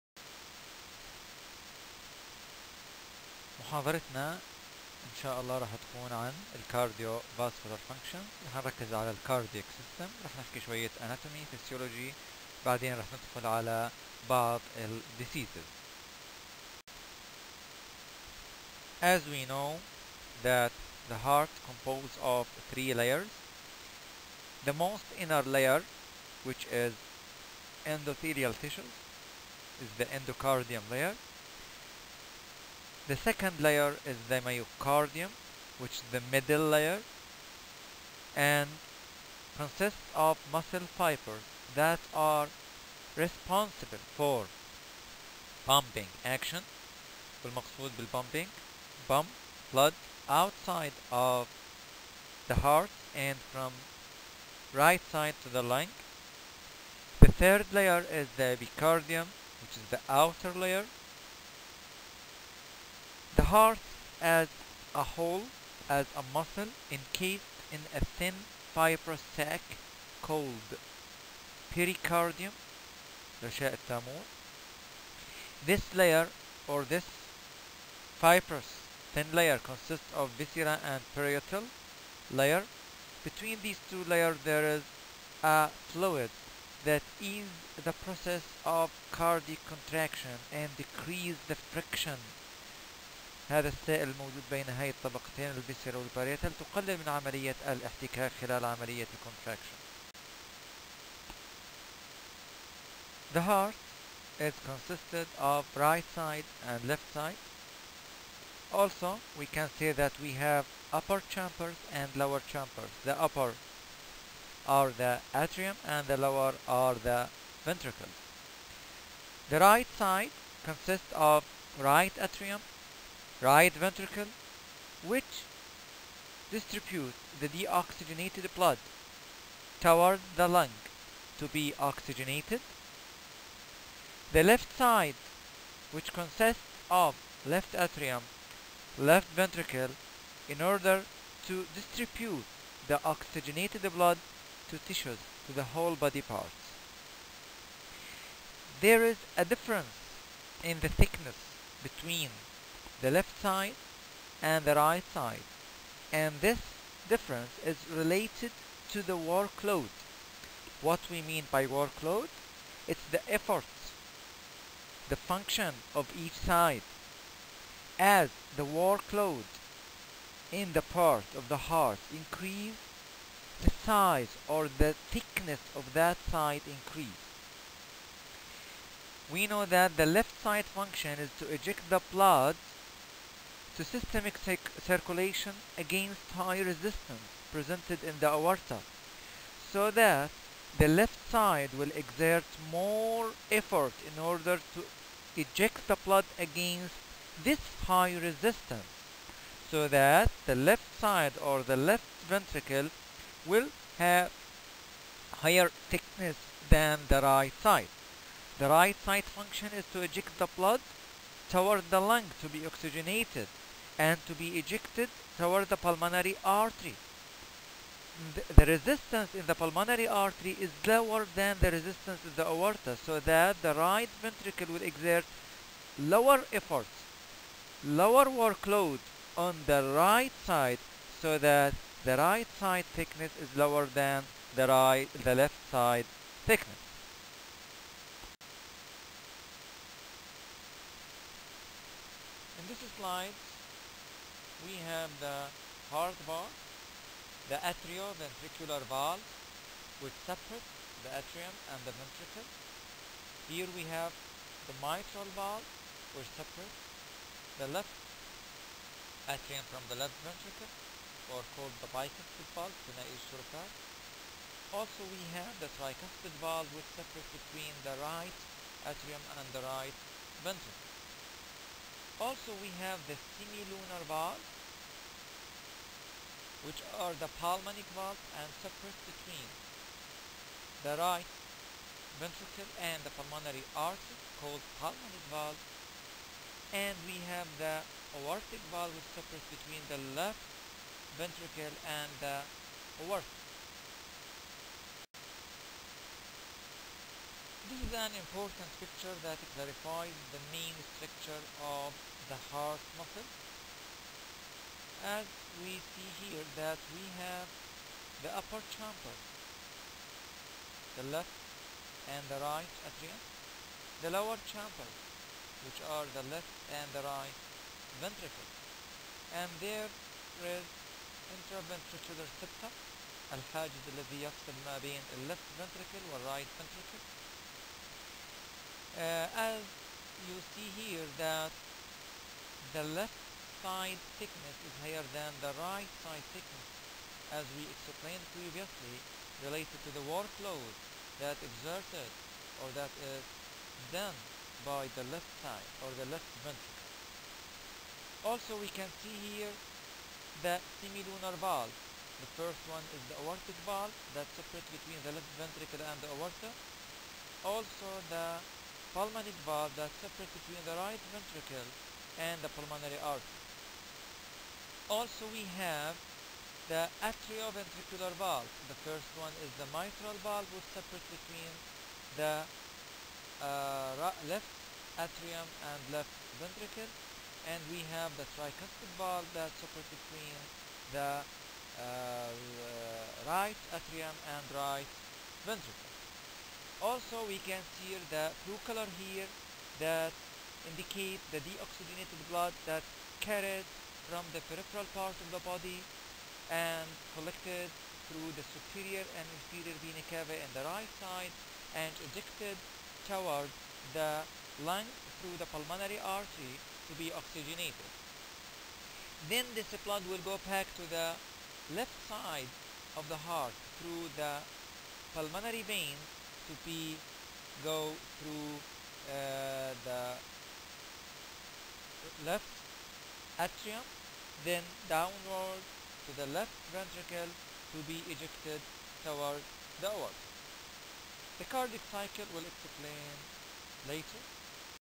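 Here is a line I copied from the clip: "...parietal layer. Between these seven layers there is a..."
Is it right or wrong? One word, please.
wrong.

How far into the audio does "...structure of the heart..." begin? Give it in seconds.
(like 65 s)
300 s.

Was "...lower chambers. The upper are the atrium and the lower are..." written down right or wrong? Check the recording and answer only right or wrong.
right.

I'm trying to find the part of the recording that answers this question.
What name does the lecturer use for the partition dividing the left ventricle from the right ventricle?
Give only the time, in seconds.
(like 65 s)
321 s.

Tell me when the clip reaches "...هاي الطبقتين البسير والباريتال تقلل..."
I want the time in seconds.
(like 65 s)
94 s.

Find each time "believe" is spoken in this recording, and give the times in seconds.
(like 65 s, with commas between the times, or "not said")
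not said.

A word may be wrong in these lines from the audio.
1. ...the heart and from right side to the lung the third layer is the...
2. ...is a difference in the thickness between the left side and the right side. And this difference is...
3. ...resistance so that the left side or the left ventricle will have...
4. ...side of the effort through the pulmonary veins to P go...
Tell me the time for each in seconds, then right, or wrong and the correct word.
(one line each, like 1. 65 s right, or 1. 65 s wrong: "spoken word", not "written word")
1. 52 s right
2. 149 s right
3. 198 s right
4. 412 s wrong: "heart", not "effort".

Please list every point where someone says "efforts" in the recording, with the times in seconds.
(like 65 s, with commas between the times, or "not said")
163 s, 193 s, 226 s.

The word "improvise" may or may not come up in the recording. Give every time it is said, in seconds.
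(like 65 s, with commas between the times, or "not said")
not said.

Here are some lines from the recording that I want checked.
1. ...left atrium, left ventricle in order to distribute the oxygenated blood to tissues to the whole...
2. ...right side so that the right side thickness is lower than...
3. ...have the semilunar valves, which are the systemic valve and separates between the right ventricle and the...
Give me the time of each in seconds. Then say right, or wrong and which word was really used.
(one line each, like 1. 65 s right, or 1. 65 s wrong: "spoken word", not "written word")
1. 137 s right
2. 229 s right
3. 272 s wrong: "pulmonic", not "systemic".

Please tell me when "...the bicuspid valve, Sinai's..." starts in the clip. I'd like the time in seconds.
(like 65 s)
261 s.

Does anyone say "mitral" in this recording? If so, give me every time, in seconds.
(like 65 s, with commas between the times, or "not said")
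254 s, 369 s.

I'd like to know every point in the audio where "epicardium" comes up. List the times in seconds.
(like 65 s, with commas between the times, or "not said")
58 s.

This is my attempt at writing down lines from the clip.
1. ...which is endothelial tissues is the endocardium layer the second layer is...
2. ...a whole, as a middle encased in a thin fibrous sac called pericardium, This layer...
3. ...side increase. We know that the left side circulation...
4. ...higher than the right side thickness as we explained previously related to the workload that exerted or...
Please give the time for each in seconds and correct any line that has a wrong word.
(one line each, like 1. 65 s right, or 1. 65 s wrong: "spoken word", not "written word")
1. 26 s right
2. 64 s wrong: "muscle", not "middle"
3. 176 s wrong: "function", not "circulation"
4. 334 s right.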